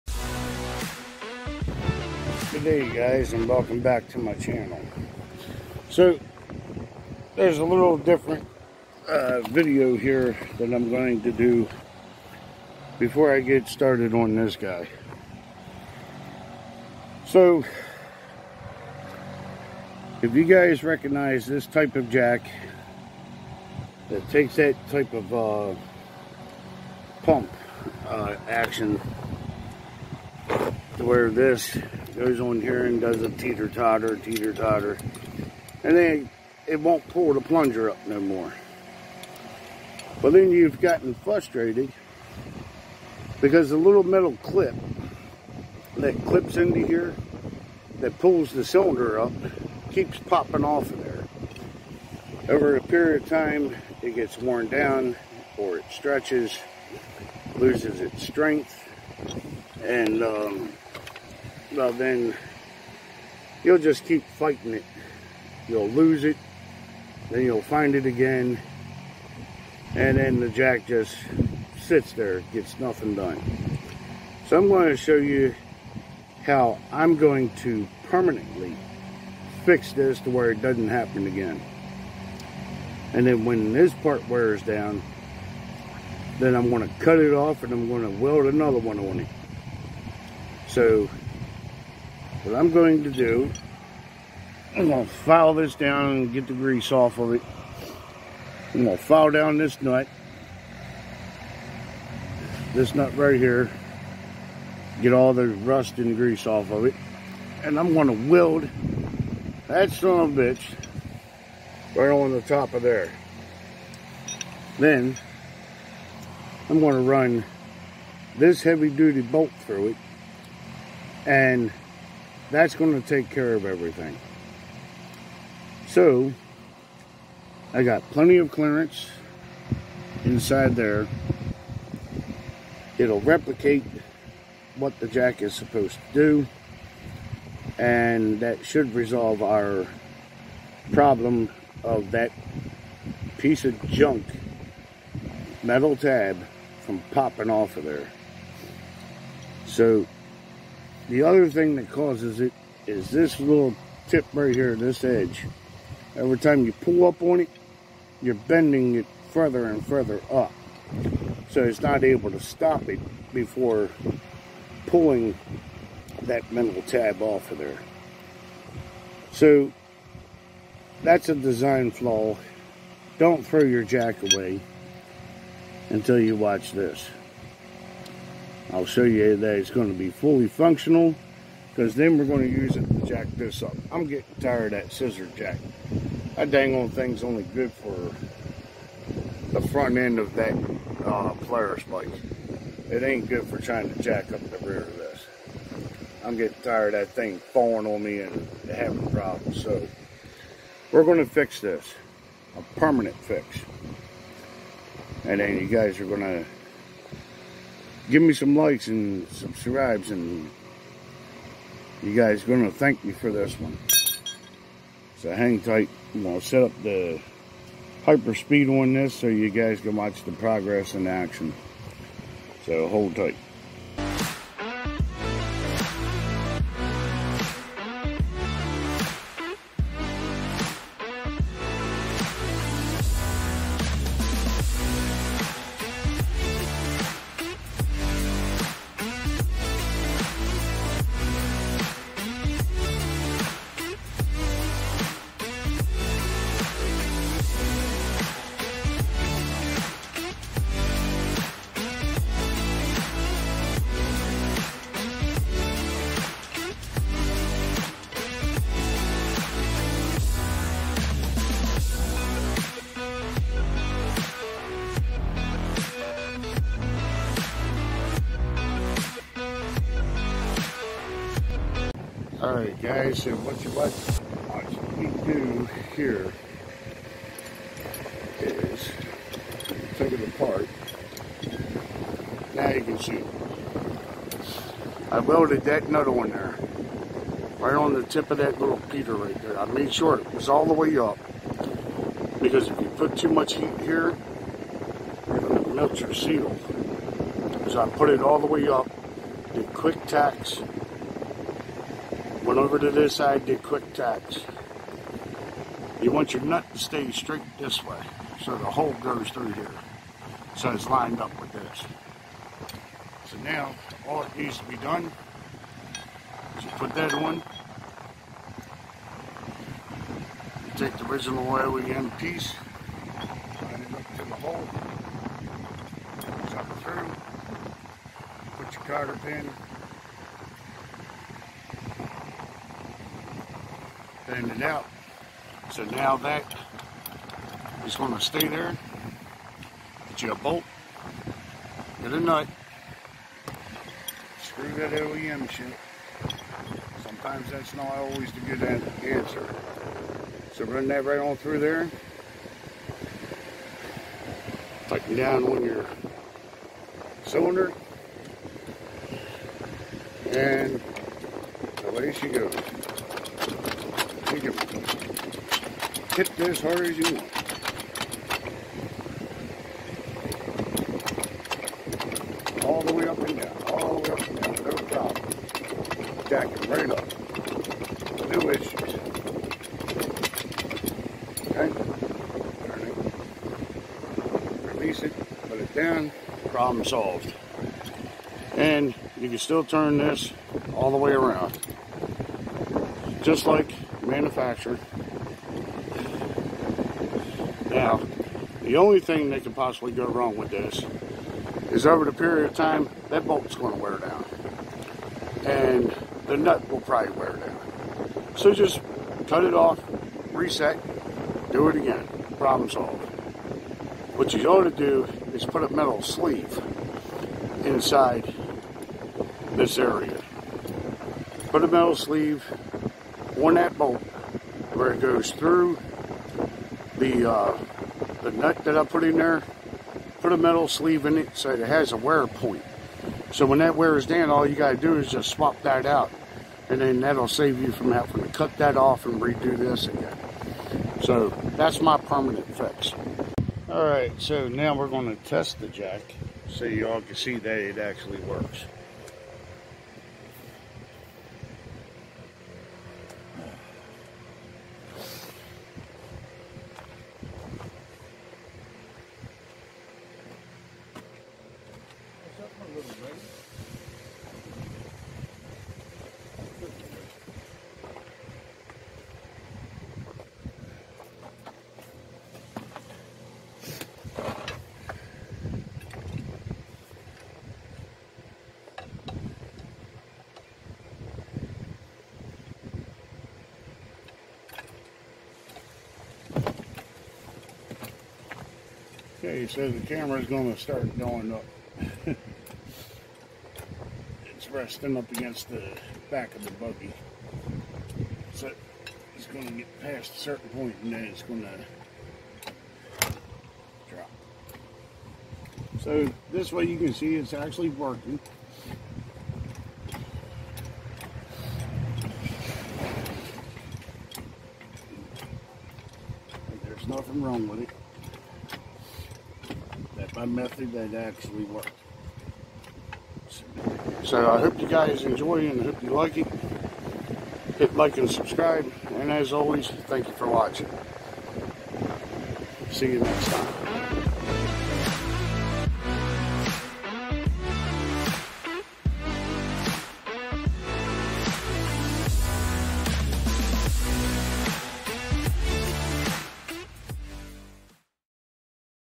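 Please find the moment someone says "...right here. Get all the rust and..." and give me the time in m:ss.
1:43.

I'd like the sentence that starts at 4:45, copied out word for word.
I welded that nut on there.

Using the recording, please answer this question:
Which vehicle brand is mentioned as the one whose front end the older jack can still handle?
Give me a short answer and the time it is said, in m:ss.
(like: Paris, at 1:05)
Polaris, at 3:11.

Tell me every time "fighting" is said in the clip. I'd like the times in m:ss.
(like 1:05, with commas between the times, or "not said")
1:04.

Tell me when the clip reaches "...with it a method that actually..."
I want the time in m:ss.
8:37.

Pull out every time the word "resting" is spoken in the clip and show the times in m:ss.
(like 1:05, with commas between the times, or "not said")
8:14.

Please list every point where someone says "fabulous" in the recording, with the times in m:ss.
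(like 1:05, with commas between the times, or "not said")
not said.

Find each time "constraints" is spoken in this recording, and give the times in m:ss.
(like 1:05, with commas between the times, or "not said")
not said.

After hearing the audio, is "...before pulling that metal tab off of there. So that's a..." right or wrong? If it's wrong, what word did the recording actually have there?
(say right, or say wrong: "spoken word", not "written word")
right.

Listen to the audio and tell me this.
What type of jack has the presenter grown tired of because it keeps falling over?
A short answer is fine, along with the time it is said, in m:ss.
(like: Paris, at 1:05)
scissor jack, at 3:04.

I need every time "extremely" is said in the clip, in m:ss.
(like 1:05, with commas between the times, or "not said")
not said.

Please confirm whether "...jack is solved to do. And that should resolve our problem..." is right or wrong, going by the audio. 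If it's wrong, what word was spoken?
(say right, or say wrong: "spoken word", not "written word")
wrong: "supposed", not "solved".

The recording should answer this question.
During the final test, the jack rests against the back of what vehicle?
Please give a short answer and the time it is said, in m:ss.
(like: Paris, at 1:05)
buggy, at 8:16.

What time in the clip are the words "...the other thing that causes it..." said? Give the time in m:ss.
2:31.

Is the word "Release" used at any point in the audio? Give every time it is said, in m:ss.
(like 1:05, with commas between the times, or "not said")
6:24.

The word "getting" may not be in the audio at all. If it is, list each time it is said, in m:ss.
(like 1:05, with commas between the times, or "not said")
3:04, 3:16.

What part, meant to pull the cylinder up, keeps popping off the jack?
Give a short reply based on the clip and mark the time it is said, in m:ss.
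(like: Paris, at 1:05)
little metal clip, at 0:43.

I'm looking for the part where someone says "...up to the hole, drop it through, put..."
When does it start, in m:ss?
5:23.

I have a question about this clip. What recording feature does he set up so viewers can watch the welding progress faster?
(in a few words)
hyper speed.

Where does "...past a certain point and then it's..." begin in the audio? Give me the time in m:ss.
8:19.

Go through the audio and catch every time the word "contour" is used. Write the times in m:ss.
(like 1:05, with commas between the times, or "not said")
not said.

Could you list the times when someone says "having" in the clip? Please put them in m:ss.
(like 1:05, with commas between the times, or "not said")
3:18, 7:17.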